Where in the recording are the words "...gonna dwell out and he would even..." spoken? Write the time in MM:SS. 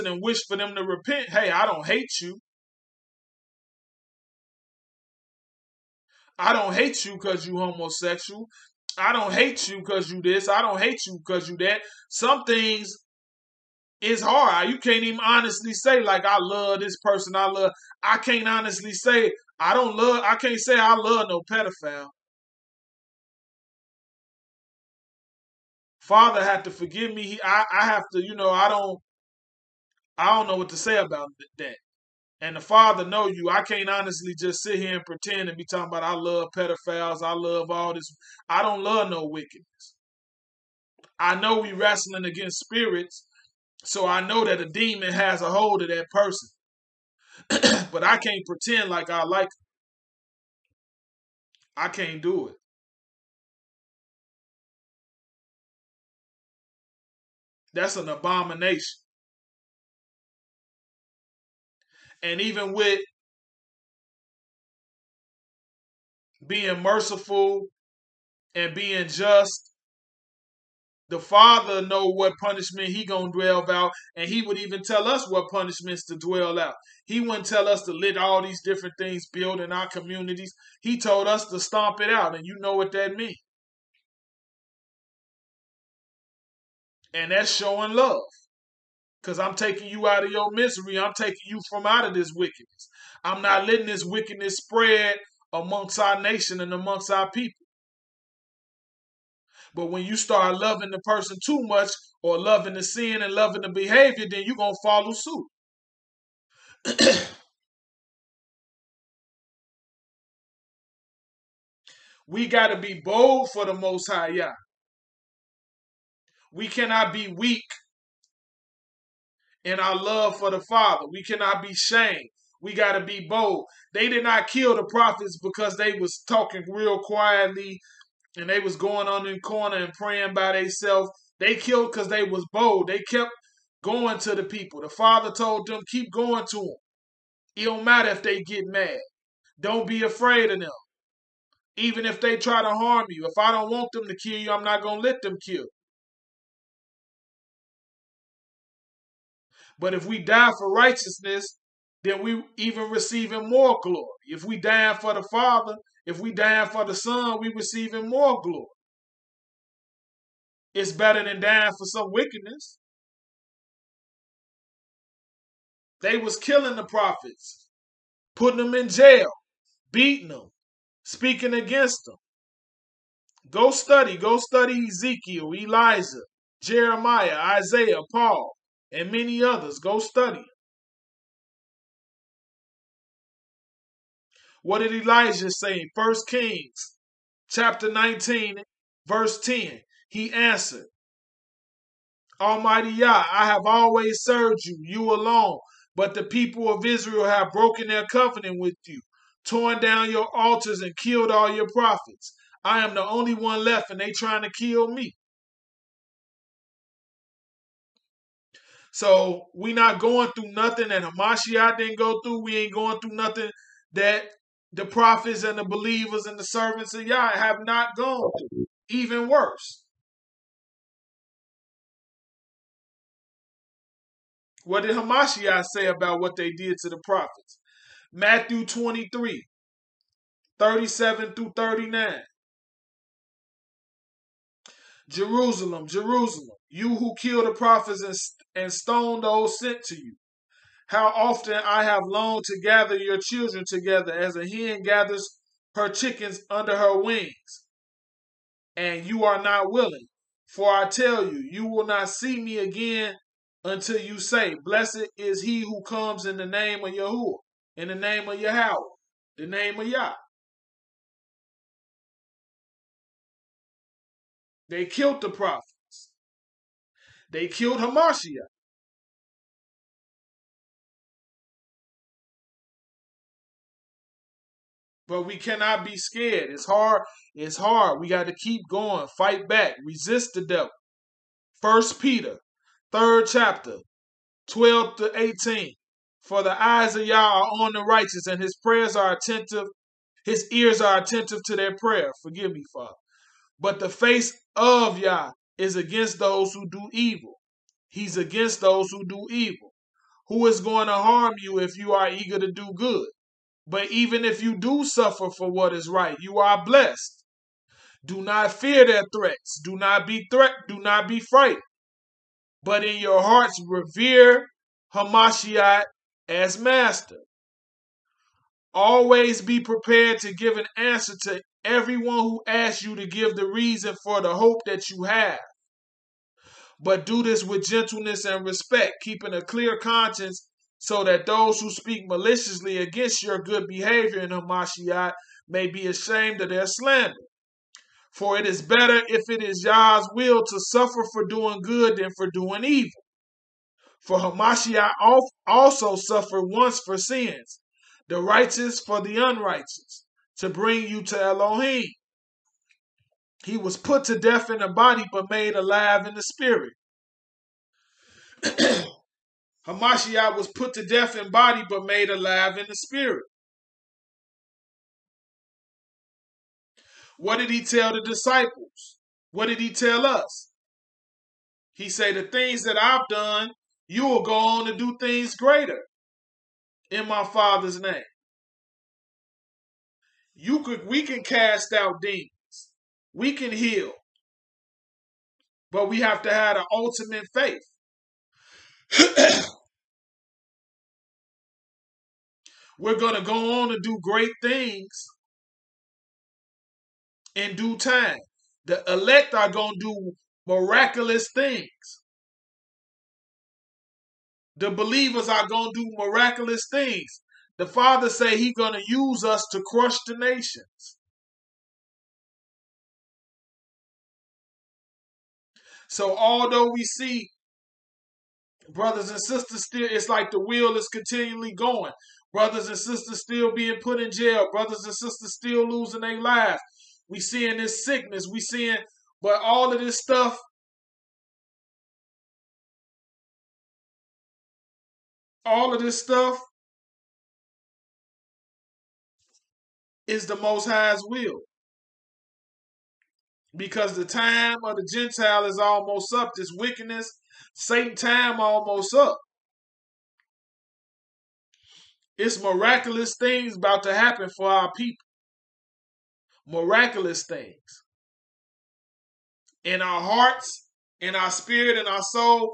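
01:13.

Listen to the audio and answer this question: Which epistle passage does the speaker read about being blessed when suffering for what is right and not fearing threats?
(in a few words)
1 Peter 3:12-18.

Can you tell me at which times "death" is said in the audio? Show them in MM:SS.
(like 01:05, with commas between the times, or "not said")
05:54, 06:00.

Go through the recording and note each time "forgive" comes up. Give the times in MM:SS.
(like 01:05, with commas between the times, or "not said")
00:26, 04:52.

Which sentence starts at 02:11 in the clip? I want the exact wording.
They killed because they was bold.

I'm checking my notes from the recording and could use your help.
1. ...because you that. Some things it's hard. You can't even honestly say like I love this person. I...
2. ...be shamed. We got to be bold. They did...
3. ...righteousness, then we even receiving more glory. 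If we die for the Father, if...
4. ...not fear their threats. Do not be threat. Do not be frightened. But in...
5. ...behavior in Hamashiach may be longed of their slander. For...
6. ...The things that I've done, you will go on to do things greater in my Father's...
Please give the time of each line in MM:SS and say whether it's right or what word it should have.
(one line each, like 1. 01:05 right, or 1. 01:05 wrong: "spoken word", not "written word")
1. 00:11 right
2. 02:01 right
3. 02:30 right
4. 05:08 right
5. 05:33 wrong: "ashamed", not "longed"
6. 06:12 right.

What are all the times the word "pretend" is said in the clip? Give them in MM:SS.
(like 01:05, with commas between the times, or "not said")
00:35, 00:48.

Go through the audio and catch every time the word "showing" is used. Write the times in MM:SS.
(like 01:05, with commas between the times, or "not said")
01:27.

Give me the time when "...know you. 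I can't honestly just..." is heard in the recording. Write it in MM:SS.
00:33.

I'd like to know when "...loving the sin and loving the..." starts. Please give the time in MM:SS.
01:42.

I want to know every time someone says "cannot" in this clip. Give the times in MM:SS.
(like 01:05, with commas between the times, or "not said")
01:56, 02:01, 04:35.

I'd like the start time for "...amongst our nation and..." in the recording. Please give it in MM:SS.
01:35.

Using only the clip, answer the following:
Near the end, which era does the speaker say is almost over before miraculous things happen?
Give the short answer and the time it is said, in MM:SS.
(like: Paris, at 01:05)
time of the Gentile, at 07:24.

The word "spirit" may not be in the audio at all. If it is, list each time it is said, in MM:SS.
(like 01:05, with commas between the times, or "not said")
00:42, 05:56, 06:02, 07:41.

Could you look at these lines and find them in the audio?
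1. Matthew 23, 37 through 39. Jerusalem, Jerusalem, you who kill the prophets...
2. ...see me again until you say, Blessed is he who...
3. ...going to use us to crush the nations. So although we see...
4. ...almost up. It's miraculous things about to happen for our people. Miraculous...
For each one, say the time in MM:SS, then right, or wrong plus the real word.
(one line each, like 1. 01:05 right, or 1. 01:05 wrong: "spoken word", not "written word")
1. 03:48 right
2. 04:12 right
3. 06:48 right
4. 07:28 right.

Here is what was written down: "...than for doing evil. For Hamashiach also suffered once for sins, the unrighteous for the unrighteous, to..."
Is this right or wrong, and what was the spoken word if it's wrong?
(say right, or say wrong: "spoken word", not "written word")
wrong: "righteous", not "unrighteous".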